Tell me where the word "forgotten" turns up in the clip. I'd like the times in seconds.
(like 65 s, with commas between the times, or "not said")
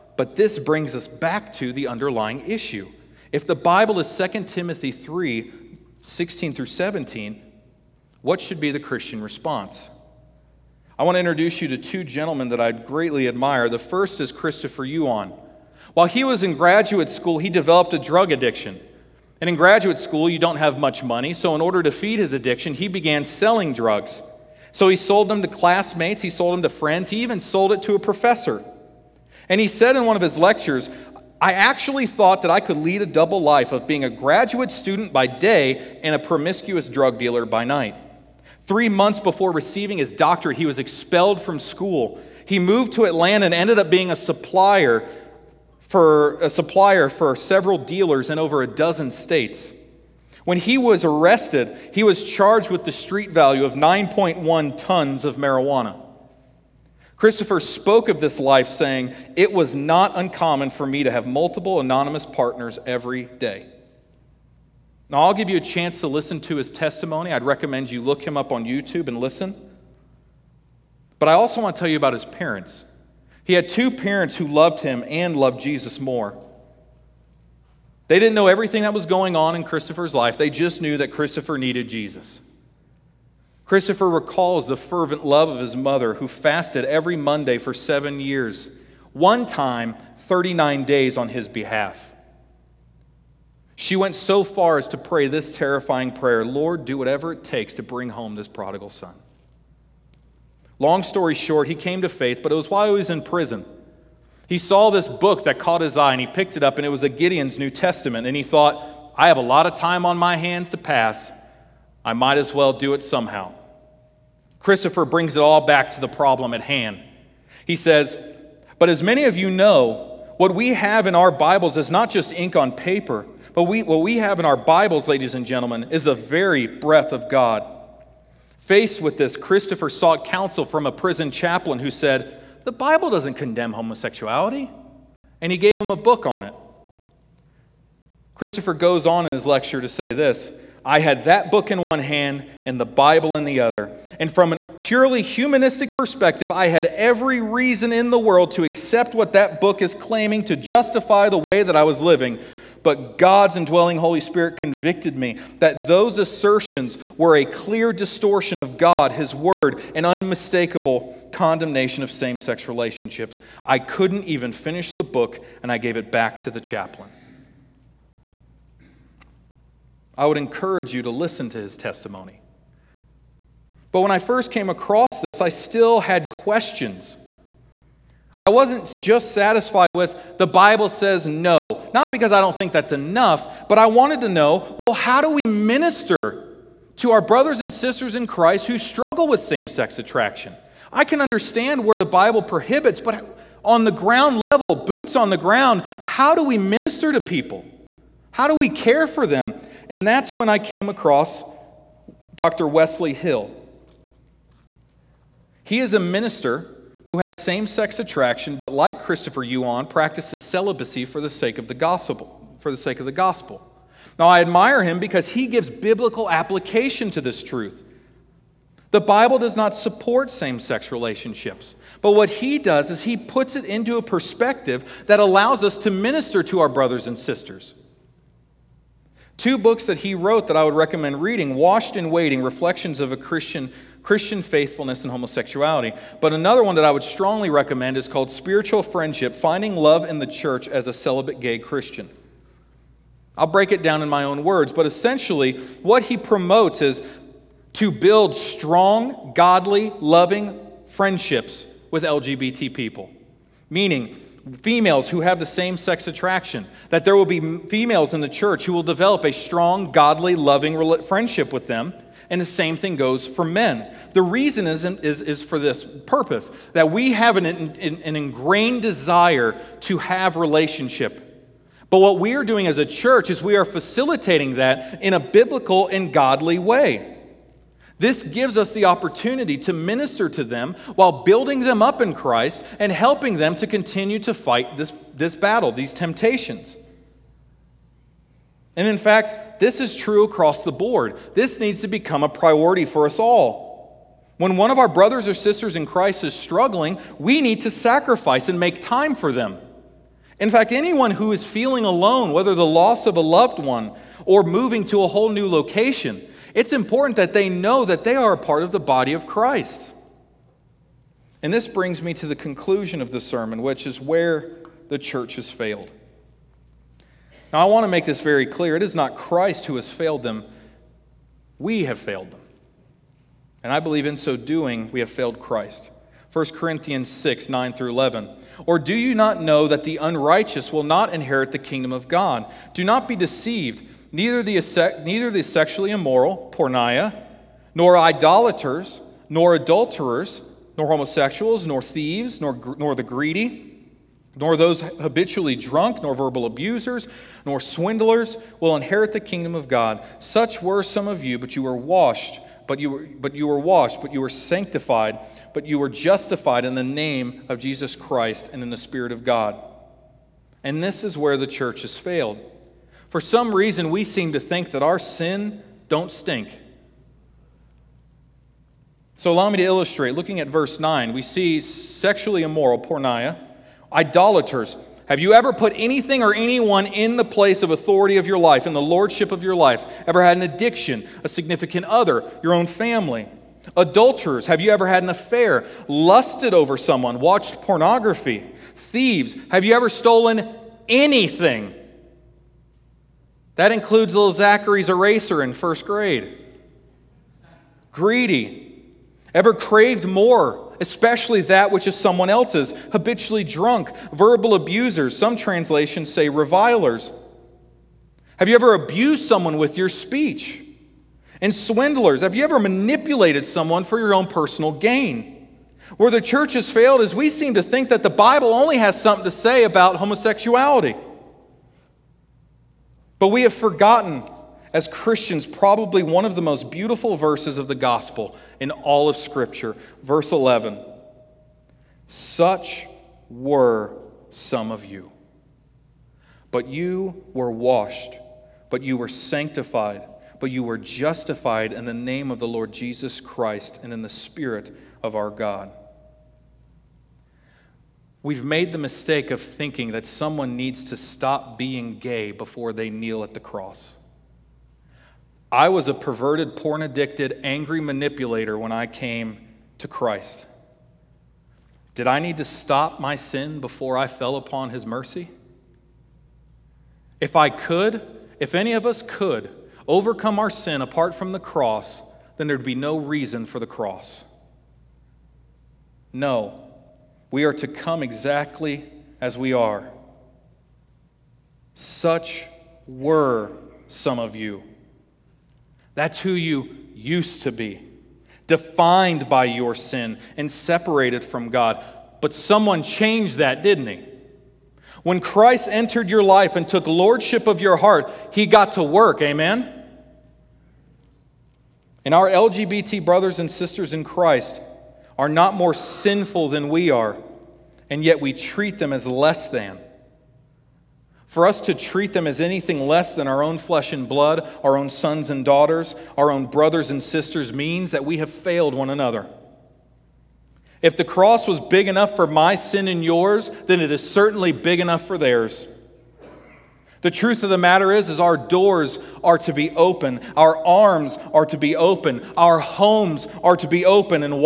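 423 s.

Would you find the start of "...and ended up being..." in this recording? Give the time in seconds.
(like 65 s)
43 s.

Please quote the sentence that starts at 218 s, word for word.
The Bible does not support same sex relationships.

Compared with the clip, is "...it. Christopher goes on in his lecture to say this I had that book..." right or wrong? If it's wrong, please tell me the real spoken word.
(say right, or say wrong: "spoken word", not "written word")
right.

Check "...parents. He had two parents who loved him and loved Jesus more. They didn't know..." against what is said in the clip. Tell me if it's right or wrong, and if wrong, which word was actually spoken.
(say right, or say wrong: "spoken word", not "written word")
right.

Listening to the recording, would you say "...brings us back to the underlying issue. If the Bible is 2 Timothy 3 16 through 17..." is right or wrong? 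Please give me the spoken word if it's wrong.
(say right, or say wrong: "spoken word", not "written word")
right.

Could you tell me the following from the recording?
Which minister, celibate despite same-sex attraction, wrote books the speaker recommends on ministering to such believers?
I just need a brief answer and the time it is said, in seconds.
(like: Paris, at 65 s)
Dr. Wesley Hill, at 202 s.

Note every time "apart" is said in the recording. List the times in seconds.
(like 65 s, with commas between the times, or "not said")
470 s.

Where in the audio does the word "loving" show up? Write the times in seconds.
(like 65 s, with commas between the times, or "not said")
250 s, 260 s.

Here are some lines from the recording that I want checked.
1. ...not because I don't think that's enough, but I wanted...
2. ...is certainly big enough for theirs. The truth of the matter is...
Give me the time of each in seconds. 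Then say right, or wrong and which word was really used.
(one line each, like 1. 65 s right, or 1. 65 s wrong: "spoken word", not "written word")
1. 181 s right
2. 523 s right.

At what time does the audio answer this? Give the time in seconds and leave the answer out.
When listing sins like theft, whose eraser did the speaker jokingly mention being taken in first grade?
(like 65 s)
394 s.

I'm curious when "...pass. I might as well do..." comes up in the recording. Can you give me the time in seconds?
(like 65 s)
110 s.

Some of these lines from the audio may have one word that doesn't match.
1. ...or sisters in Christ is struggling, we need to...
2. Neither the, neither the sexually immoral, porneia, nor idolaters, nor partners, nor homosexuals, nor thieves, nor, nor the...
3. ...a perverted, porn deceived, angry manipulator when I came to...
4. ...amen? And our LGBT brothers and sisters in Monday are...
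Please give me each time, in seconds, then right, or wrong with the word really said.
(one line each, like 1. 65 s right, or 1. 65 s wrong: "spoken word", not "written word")
1. 295 s right
2. 334 s wrong: "adulterers", not "partners"
3. 455 s wrong: "addicted", not "deceived"
4. 499 s wrong: "Christ", not "Monday".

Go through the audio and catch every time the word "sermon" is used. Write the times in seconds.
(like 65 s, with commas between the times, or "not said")
313 s.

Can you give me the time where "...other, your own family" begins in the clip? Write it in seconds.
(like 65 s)
381 s.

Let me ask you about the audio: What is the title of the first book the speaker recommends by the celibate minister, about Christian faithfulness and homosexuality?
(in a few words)
Washed and Waiting.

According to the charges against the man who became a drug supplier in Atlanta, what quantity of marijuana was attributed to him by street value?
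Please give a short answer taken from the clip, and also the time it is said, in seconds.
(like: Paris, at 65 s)
9.1 tons, at 53 s.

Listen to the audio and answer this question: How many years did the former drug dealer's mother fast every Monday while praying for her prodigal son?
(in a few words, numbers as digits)
7.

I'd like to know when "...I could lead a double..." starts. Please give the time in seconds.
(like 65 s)
32 s.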